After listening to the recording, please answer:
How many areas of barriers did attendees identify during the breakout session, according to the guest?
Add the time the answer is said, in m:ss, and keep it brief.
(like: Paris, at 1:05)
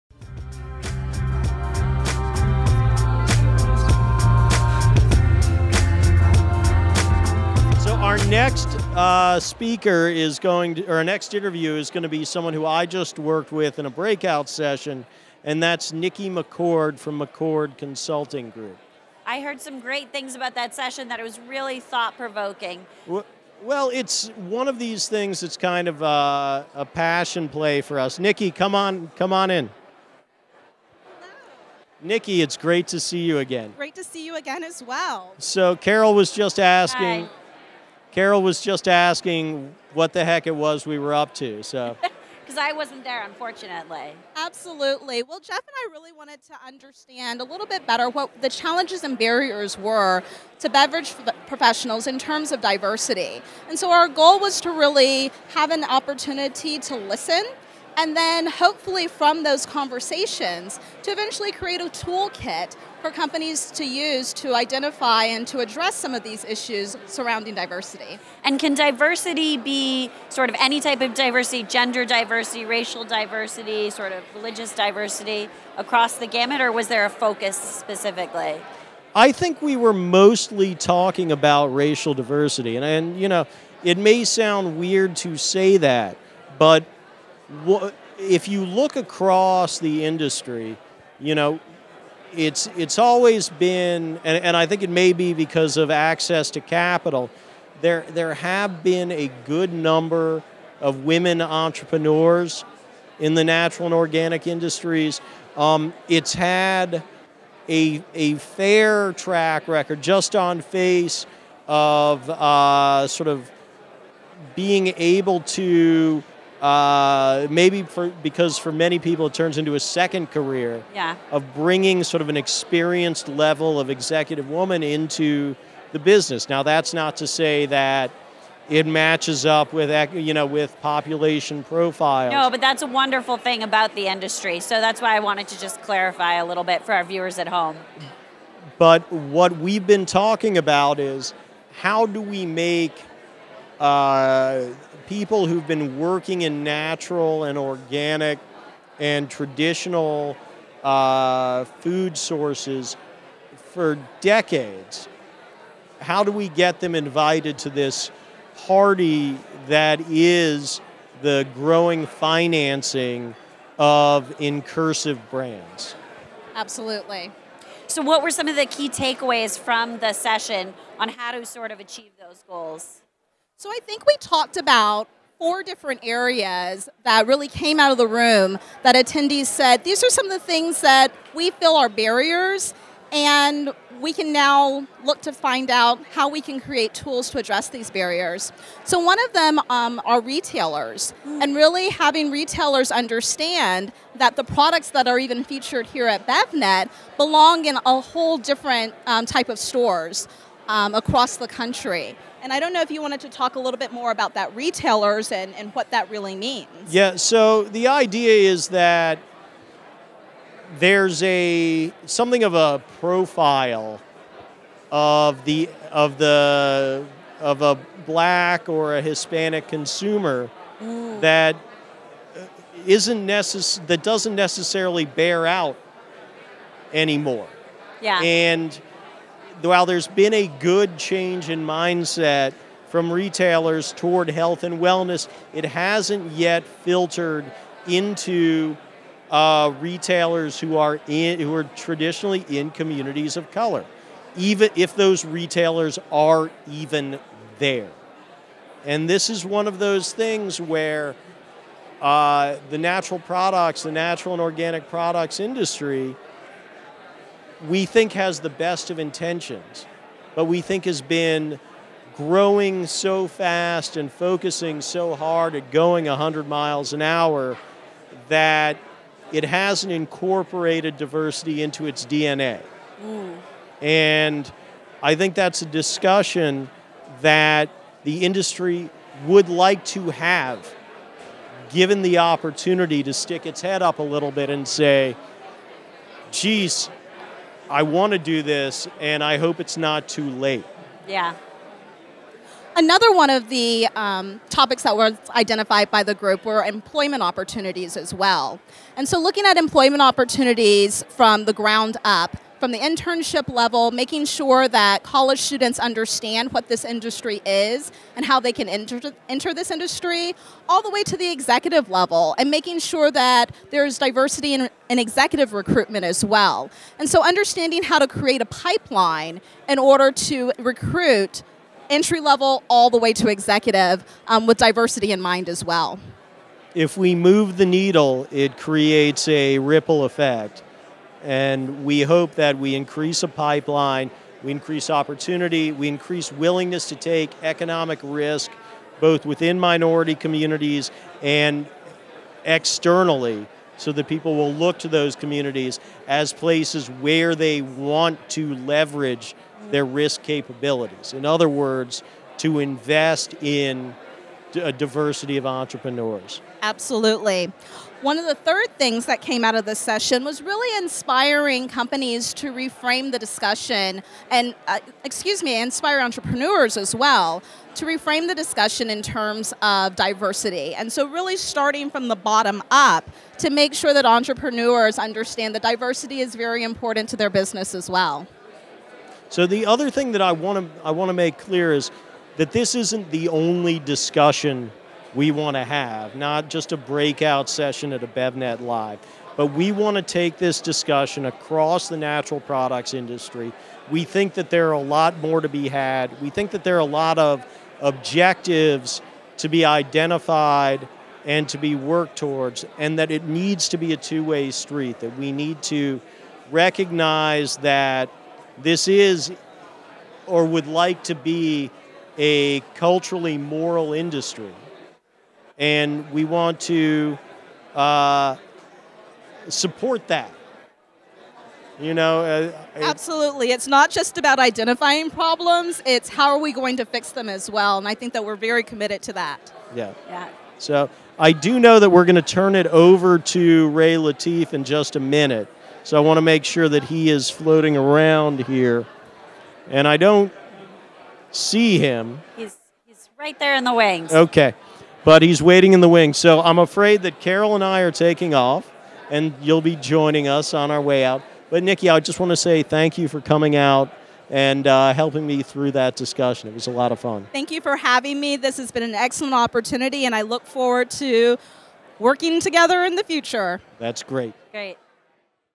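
4, at 2:55.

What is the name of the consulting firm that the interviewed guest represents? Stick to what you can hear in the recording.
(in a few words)
McCord Consulting Group.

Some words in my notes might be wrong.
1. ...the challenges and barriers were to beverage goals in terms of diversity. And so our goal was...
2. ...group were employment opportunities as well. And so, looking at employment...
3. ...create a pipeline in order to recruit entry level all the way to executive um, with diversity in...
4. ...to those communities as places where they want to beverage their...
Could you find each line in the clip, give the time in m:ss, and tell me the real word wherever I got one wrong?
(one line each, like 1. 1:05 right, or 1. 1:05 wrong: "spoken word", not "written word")
1. 0:48 wrong: "professionals", not "goals"
2. 4:56 right
3. 5:18 right
4. 5:44 wrong: "leverage", not "beverage".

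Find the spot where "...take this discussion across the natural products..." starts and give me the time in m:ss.
6:30.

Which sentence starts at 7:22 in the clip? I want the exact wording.
He's, he's right there in the wings.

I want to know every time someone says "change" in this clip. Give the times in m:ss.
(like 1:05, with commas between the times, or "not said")
3:50.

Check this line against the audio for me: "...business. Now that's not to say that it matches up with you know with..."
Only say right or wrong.
right.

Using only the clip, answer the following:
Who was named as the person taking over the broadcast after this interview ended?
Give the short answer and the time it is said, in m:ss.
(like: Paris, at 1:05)
Ray Latif, at 7:13.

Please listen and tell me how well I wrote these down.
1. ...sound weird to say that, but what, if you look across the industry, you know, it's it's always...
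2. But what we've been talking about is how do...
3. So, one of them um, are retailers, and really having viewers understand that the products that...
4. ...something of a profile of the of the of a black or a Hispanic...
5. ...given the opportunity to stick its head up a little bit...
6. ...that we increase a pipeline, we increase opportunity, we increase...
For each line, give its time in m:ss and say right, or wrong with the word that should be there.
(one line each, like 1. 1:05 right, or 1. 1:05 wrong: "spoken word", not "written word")
1. 1:24 right
2. 2:18 right
3. 3:08 wrong: "retailers", not "viewers"
4. 3:32 right
5. 4:41 right
6. 5:32 right.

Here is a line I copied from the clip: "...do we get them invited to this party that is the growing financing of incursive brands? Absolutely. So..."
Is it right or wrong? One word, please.
right.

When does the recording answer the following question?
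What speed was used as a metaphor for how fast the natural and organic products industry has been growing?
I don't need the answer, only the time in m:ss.
4:26.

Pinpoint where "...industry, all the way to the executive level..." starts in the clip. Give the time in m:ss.
5:09.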